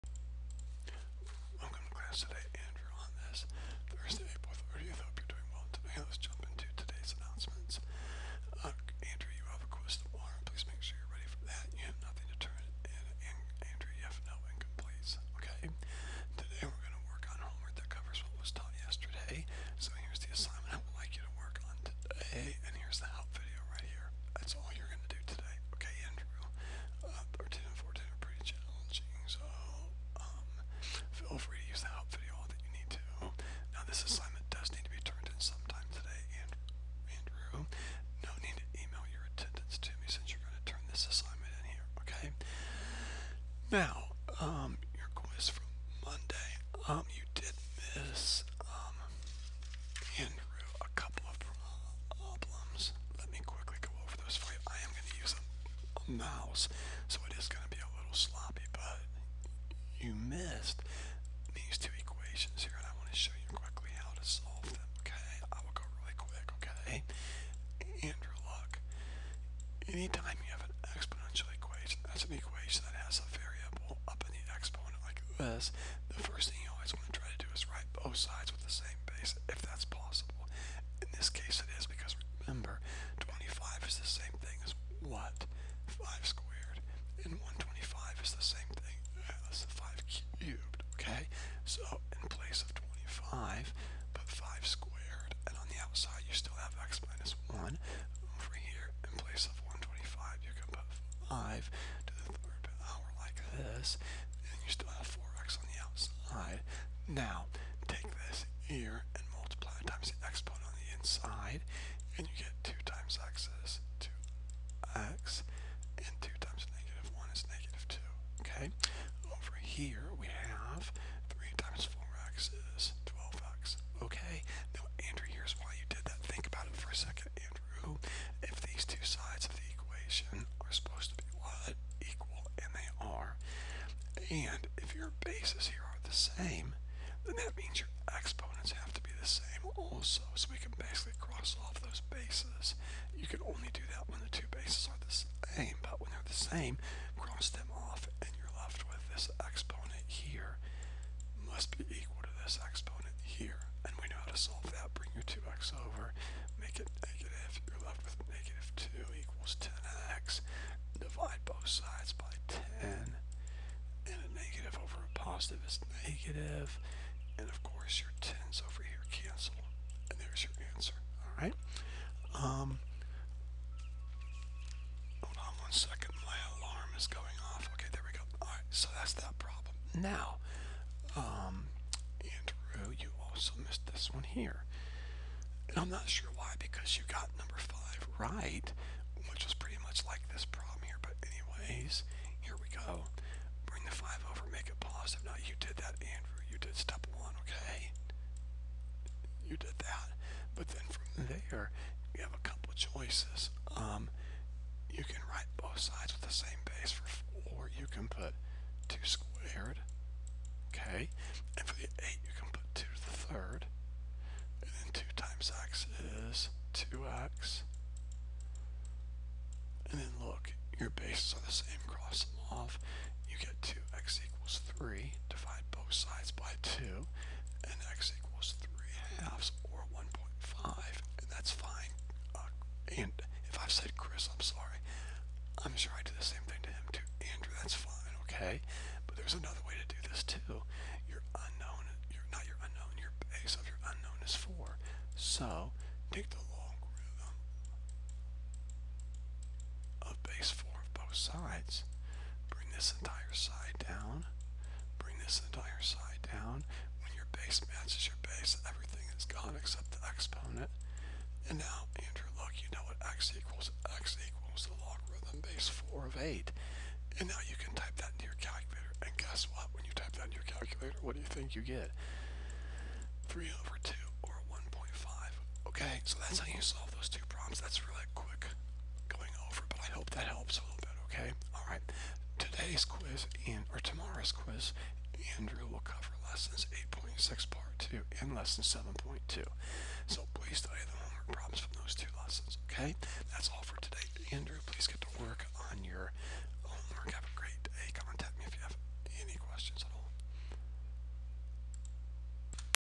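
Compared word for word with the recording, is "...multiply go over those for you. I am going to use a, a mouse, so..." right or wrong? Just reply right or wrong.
wrong.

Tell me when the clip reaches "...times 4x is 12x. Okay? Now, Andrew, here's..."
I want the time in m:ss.
2:01.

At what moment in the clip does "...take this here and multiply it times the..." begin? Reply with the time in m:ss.
1:47.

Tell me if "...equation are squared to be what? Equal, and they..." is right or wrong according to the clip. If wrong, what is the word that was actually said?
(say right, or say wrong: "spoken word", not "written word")
wrong: "supposed", not "squared".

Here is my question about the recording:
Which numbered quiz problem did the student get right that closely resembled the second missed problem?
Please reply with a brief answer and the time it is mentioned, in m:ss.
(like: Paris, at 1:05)
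5, at 3:07.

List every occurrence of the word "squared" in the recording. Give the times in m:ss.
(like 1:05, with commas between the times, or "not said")
1:26, 3:29.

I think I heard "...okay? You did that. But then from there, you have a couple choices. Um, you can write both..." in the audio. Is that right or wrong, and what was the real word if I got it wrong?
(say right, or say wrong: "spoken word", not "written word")
right.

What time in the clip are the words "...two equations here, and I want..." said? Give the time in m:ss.
1:01.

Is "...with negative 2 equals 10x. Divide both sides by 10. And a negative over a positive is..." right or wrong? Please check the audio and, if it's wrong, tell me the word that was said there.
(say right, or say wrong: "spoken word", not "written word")
right.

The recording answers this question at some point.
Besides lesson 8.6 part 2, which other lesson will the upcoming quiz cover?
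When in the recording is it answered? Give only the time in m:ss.
4:48.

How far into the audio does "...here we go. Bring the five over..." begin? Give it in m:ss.
3:12.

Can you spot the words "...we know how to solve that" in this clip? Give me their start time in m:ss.
2:34.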